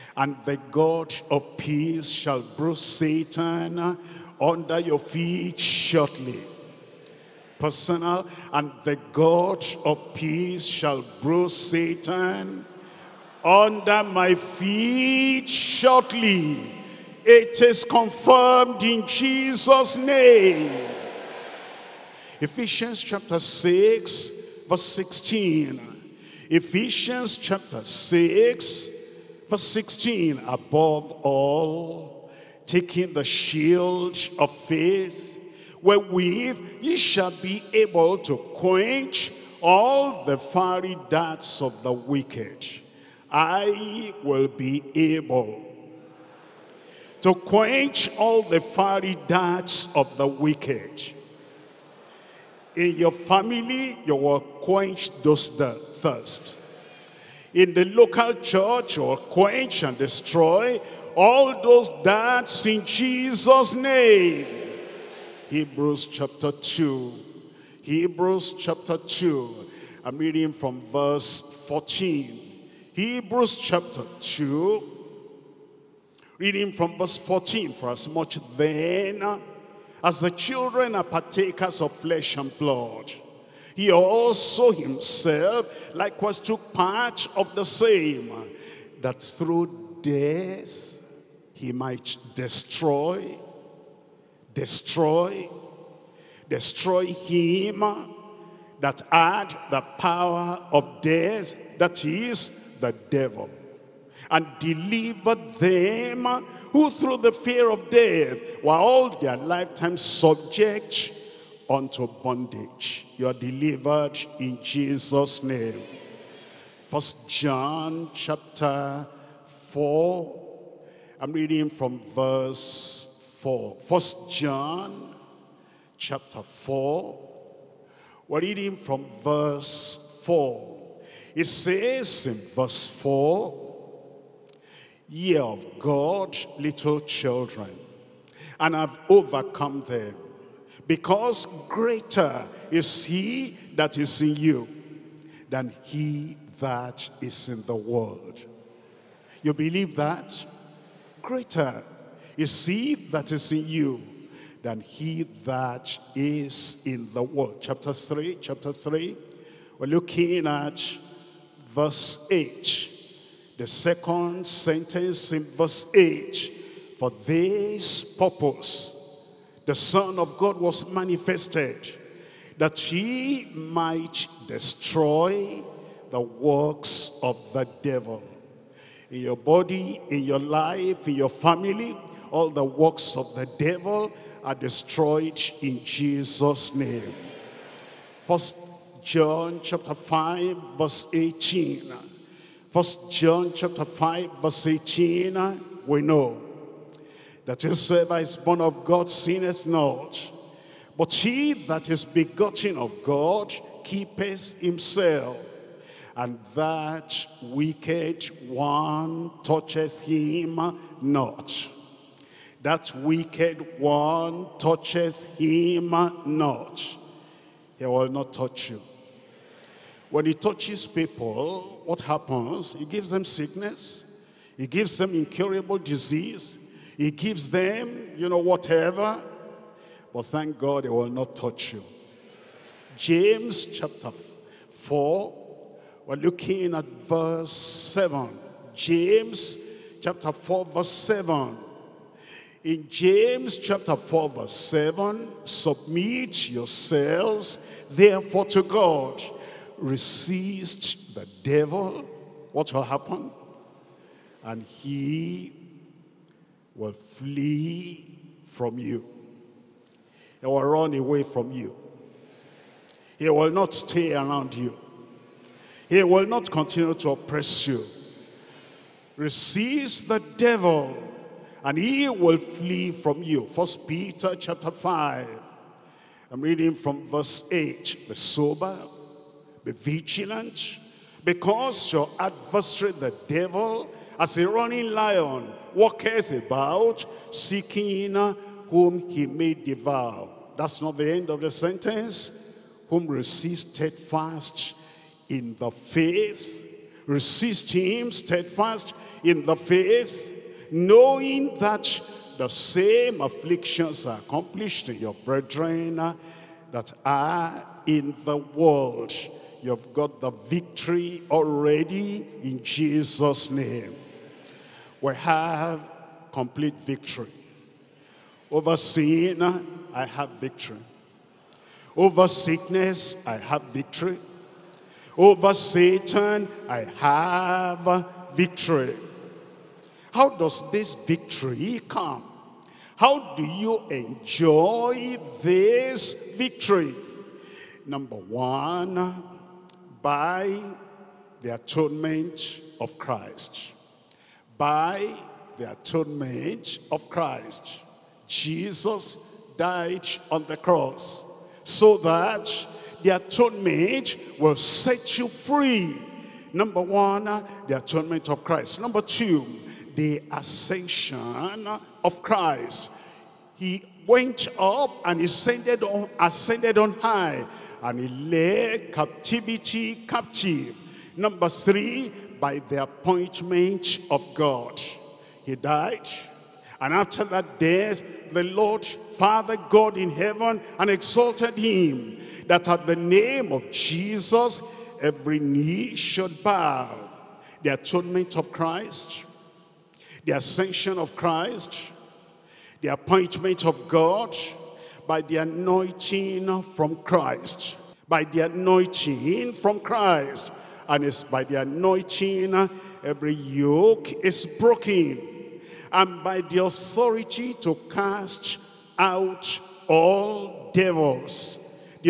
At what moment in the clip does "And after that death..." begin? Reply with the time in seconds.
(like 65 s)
376 s.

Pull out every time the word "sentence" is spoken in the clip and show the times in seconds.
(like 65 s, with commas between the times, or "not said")
164 s, 291 s.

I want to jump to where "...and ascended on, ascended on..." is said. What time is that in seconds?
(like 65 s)
365 s.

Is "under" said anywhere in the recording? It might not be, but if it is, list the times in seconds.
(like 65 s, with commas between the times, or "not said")
4 s, 13 s.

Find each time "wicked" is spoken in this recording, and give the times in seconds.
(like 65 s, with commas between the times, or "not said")
41 s, 50 s, 207 s, 212 s.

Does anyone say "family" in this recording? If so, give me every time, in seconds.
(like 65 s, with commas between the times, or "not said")
53 s, 181 s.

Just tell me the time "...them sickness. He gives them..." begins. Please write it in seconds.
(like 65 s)
223 s.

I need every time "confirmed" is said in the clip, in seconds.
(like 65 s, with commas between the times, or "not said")
17 s.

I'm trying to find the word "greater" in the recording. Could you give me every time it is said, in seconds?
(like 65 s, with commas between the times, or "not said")
141 s, 151 s.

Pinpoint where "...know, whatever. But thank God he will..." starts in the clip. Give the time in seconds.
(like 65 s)
228 s.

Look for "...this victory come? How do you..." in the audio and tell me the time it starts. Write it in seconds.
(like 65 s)
330 s.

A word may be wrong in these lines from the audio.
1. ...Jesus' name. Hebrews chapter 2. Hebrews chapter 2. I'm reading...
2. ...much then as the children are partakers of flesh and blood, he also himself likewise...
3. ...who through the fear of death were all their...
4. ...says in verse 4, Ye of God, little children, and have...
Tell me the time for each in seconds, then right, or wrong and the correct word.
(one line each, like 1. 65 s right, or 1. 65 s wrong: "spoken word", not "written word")
1. 62 s right
2. 78 s right
3. 106 s right
4. 131 s right.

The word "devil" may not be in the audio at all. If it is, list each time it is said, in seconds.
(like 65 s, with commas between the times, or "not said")
103 s, 177 s, 183 s, 251 s, 270 s, 283 s, 410 s.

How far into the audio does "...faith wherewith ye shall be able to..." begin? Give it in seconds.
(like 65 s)
34 s.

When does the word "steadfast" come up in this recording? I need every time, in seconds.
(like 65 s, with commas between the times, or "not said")
293 s, 298 s.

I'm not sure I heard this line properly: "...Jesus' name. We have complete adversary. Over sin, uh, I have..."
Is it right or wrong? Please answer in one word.
wrong.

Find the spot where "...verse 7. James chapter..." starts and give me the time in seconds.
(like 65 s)
236 s.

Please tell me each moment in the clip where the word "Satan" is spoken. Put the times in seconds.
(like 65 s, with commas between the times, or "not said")
2 s, 11 s, 325 s.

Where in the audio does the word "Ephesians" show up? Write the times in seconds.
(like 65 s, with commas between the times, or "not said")
22 s, 26 s.